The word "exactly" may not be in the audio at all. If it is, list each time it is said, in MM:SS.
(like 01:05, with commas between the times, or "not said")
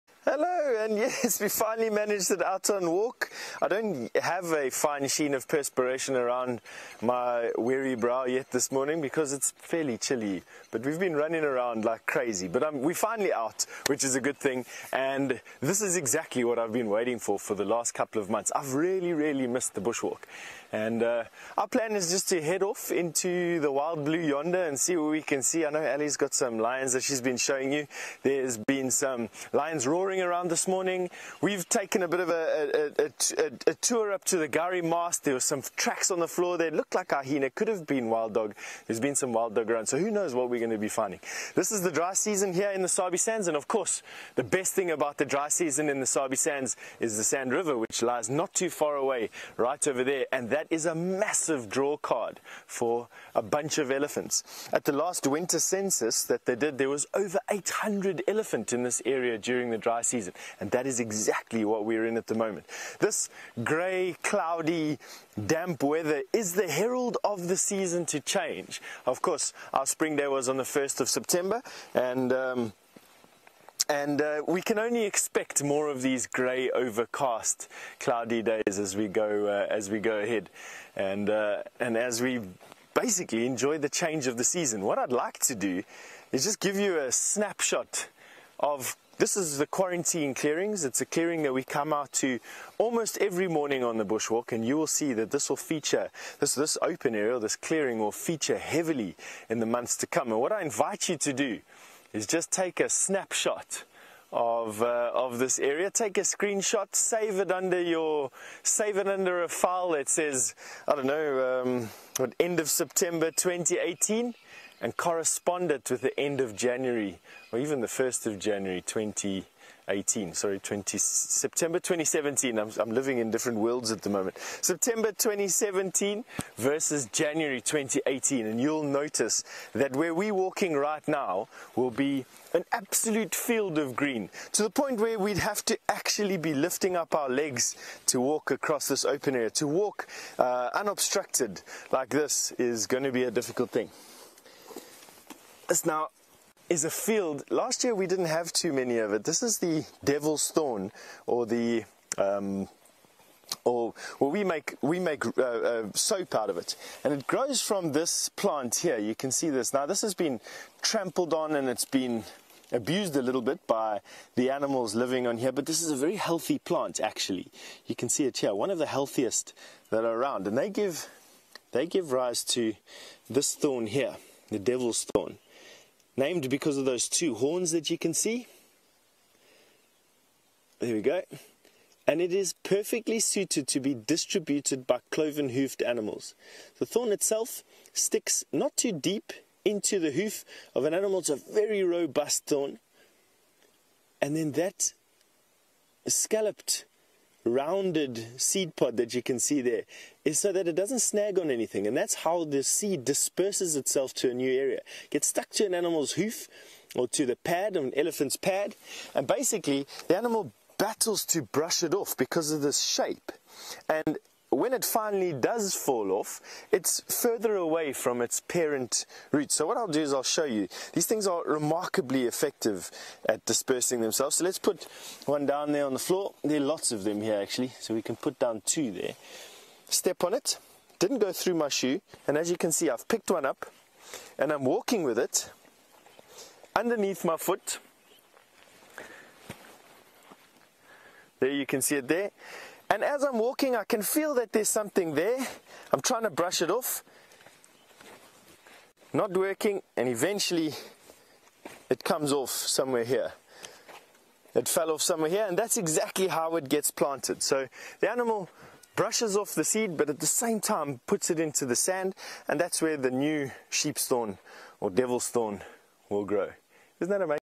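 00:15, 01:00, 04:15.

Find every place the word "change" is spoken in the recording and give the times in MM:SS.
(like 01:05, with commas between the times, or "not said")
01:08, 01:23.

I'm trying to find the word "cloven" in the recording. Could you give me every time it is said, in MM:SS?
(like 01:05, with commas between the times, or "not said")
03:05.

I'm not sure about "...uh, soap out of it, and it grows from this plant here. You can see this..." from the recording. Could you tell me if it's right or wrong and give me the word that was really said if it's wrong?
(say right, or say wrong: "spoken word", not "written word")
right.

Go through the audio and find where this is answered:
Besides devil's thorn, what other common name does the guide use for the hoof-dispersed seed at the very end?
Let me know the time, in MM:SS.
04:23.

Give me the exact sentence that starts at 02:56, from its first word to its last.
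Named because of those two horns that you can see.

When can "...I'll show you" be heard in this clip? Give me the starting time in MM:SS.
03:40.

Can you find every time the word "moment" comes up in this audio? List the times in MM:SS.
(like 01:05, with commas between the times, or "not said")
01:02, 02:04.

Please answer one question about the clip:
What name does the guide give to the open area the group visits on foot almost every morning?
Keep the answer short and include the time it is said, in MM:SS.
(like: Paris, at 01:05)
quarantine clearings, at 01:29.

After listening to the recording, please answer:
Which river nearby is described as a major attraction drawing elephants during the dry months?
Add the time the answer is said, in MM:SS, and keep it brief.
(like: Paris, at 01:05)
Sand River, at 00:47.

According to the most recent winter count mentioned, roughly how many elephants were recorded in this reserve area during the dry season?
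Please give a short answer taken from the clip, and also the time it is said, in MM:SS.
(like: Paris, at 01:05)
over 800, at 00:57.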